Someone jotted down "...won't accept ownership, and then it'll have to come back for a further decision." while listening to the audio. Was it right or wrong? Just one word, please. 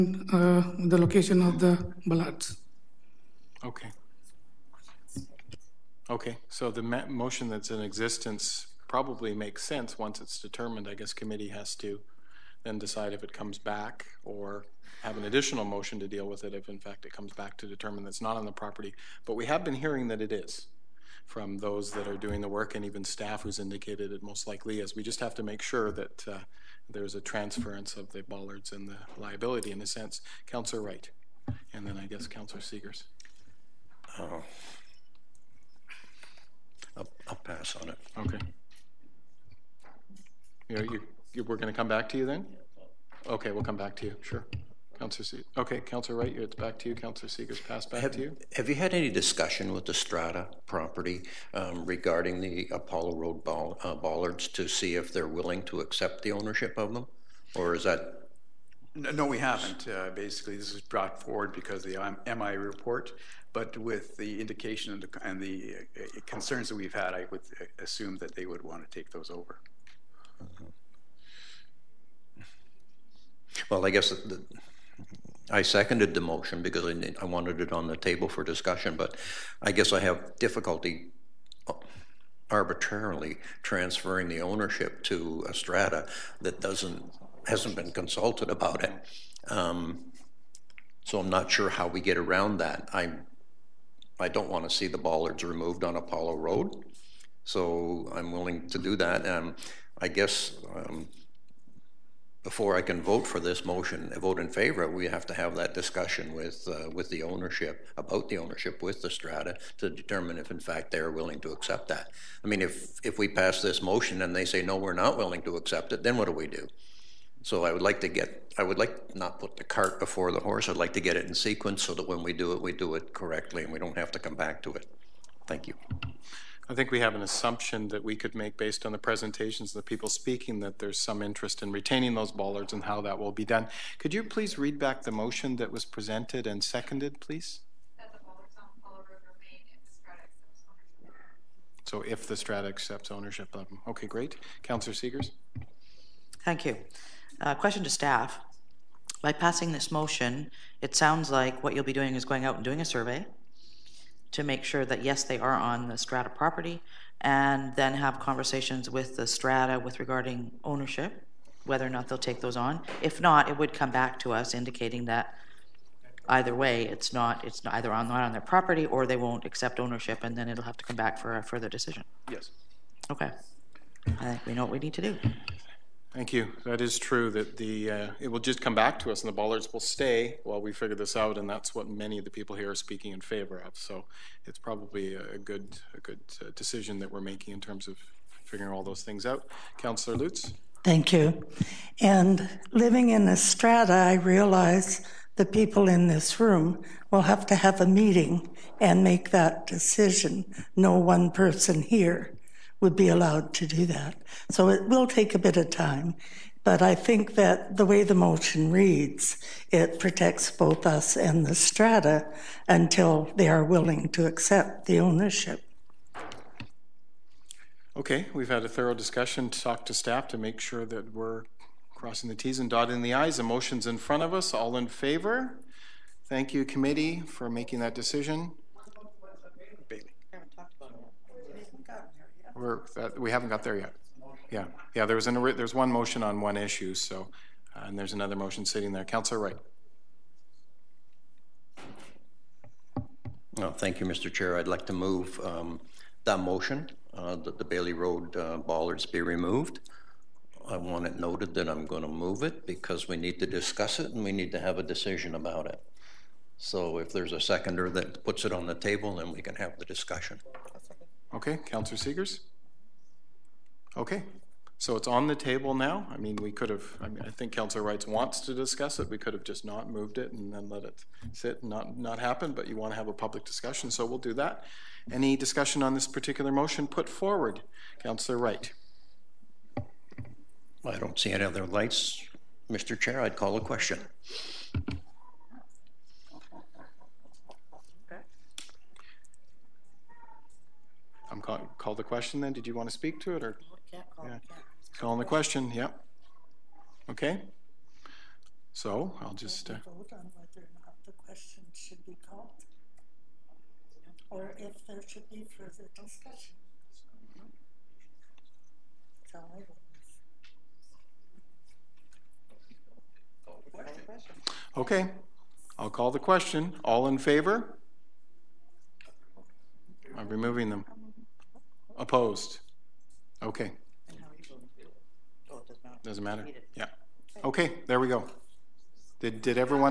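right.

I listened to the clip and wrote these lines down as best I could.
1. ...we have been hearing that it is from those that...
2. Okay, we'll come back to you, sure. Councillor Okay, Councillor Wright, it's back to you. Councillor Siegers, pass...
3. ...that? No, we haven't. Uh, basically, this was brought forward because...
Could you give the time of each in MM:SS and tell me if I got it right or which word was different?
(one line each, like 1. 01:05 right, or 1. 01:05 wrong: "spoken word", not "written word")
1. 00:19 right
2. 00:43 right
3. 00:57 right.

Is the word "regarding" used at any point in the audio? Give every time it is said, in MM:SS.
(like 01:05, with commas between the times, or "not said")
00:51, 02:39.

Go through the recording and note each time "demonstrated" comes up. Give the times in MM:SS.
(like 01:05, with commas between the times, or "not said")
not said.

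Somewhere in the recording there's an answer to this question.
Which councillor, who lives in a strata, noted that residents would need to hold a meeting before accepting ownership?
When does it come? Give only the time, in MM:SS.
03:09.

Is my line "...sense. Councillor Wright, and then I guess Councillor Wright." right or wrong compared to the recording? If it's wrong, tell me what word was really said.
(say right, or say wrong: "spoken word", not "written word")
wrong: "Siegers", not "Wright".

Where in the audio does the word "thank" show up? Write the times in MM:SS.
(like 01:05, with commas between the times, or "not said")
02:05, 02:26, 02:56, 03:10, 03:46, 04:03.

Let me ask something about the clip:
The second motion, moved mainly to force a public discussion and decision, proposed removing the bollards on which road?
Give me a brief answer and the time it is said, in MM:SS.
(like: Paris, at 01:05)
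Bailey Road, at 04:07.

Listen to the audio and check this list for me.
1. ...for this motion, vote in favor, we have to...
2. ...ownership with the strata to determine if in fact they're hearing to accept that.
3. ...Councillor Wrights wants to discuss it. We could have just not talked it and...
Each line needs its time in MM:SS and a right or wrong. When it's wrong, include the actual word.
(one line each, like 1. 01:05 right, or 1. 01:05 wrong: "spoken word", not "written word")
1. 01:43 right
2. 01:48 wrong: "willing", not "hearing"
3. 04:27 wrong: "moved", not "talked".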